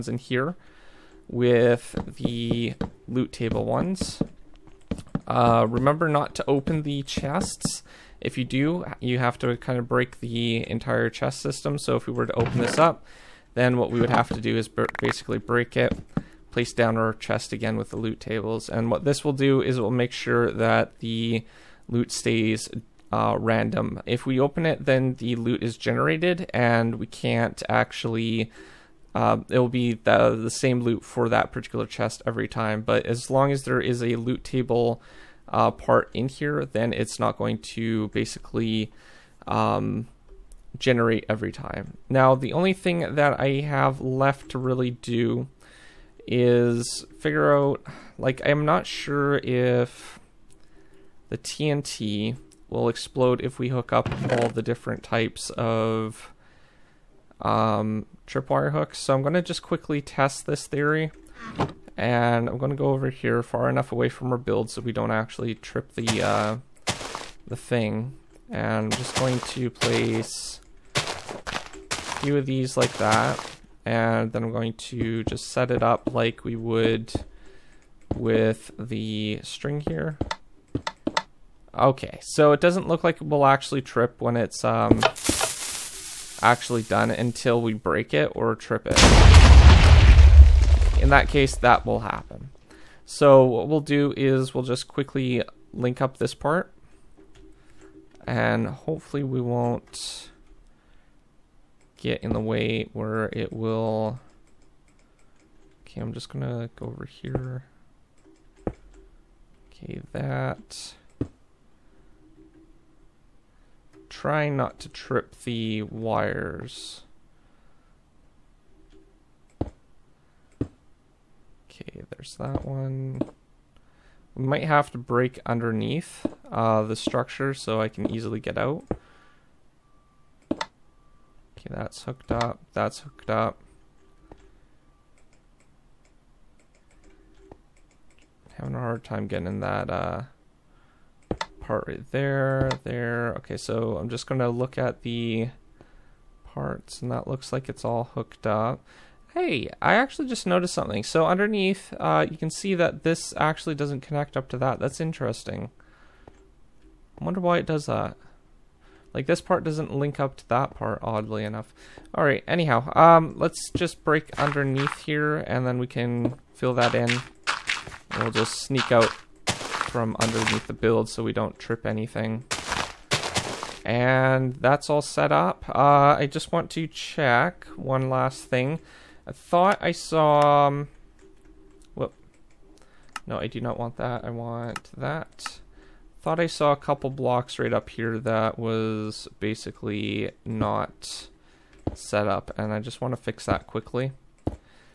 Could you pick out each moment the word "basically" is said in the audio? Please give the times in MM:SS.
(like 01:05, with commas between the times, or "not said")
00:15, 00:38, 03:09.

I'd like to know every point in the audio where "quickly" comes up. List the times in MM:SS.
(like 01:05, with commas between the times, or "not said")
00:59, 01:34, 03:13.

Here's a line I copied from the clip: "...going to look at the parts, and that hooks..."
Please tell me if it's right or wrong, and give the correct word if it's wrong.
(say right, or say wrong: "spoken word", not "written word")
wrong: "looks", not "hooks".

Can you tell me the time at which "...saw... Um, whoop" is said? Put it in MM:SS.
02:59.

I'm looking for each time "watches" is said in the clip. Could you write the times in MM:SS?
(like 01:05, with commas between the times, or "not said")
not said.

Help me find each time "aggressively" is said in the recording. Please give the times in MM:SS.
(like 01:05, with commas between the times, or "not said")
not said.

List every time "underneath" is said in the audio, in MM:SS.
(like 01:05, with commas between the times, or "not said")
02:05, 02:31, 02:44, 02:50.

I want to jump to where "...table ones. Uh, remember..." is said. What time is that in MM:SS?
00:03.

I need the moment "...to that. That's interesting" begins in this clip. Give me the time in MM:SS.
02:34.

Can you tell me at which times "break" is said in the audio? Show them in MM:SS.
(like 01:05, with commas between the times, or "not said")
00:09, 00:15, 01:27, 02:04, 02:44.